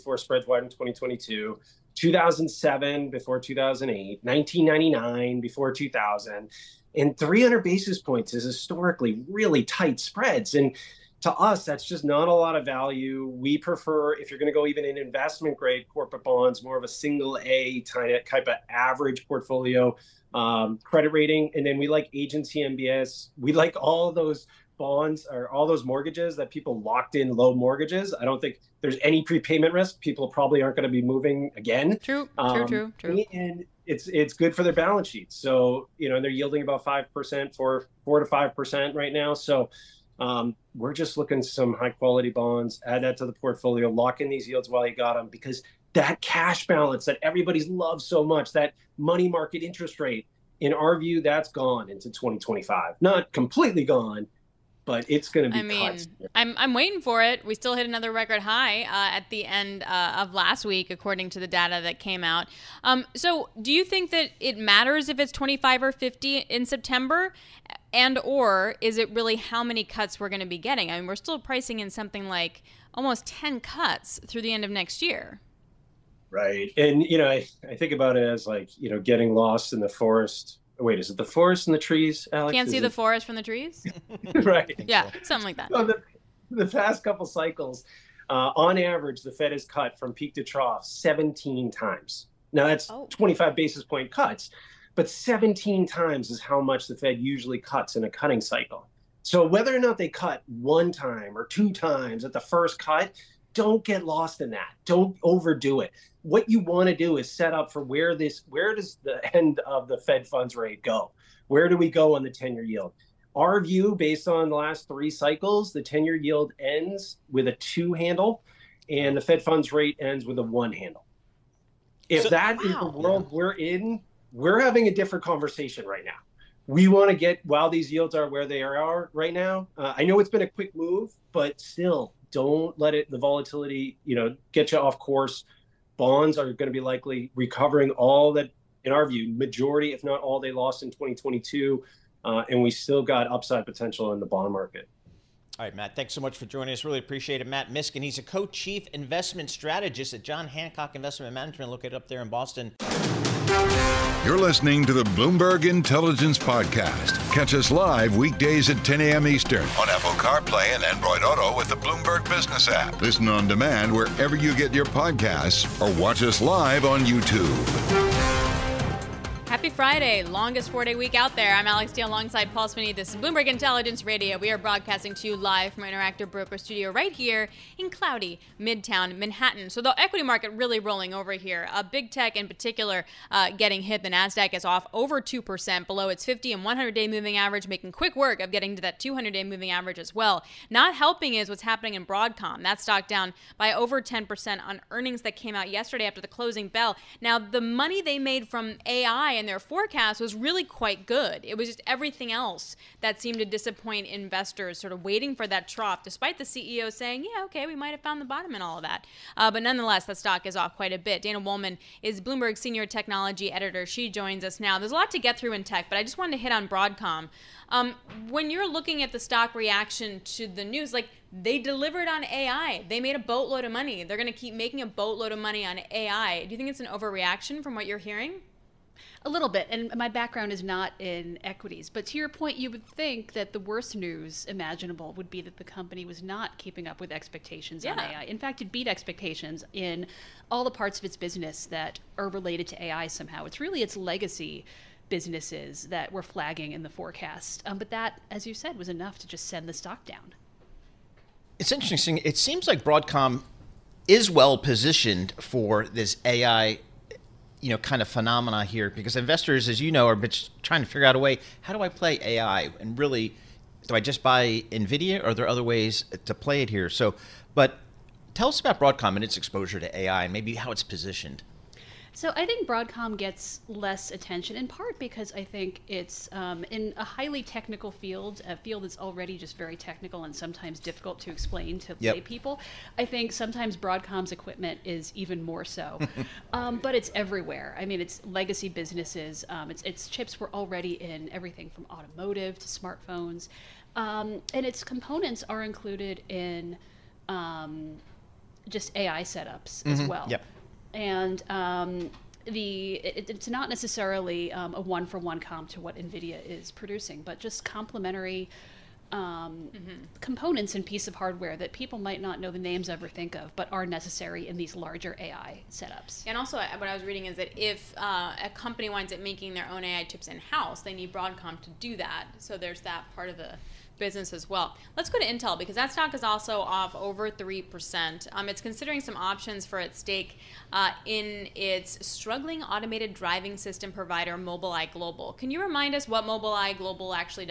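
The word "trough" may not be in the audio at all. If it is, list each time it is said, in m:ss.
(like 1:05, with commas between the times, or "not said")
1:30, 3:25.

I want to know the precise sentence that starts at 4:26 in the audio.
So, but tell us about Broadcom and its exposure to AI and maybe how it's positioned.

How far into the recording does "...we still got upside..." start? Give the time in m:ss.
2:22.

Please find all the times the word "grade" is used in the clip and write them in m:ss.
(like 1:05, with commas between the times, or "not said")
0:15.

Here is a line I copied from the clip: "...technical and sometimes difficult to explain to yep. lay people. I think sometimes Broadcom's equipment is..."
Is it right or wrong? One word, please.
right.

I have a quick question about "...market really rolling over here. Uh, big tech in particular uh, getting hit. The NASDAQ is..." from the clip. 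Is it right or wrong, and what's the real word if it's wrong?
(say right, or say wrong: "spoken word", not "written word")
right.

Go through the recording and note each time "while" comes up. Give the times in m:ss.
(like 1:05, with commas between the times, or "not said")
0:44, 2:07.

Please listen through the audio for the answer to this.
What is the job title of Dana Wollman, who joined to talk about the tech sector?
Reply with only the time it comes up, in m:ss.
3:32.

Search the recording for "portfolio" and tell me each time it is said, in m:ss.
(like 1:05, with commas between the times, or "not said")
0:19, 0:43.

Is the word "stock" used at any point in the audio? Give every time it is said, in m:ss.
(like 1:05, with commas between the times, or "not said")
3:12, 3:30, 3:39, 4:09, 5:25.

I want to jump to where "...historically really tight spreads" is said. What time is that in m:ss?
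0:08.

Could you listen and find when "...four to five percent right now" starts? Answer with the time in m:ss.
0:38.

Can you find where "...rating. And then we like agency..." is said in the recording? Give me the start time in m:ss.
0:21.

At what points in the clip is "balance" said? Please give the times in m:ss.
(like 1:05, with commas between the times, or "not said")
0:34, 0:46.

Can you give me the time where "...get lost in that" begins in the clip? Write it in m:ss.
1:43.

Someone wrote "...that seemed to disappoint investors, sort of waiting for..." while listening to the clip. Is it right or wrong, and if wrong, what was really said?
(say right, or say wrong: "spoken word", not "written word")
right.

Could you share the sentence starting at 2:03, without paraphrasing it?
we're in, we're having a different conversation right now.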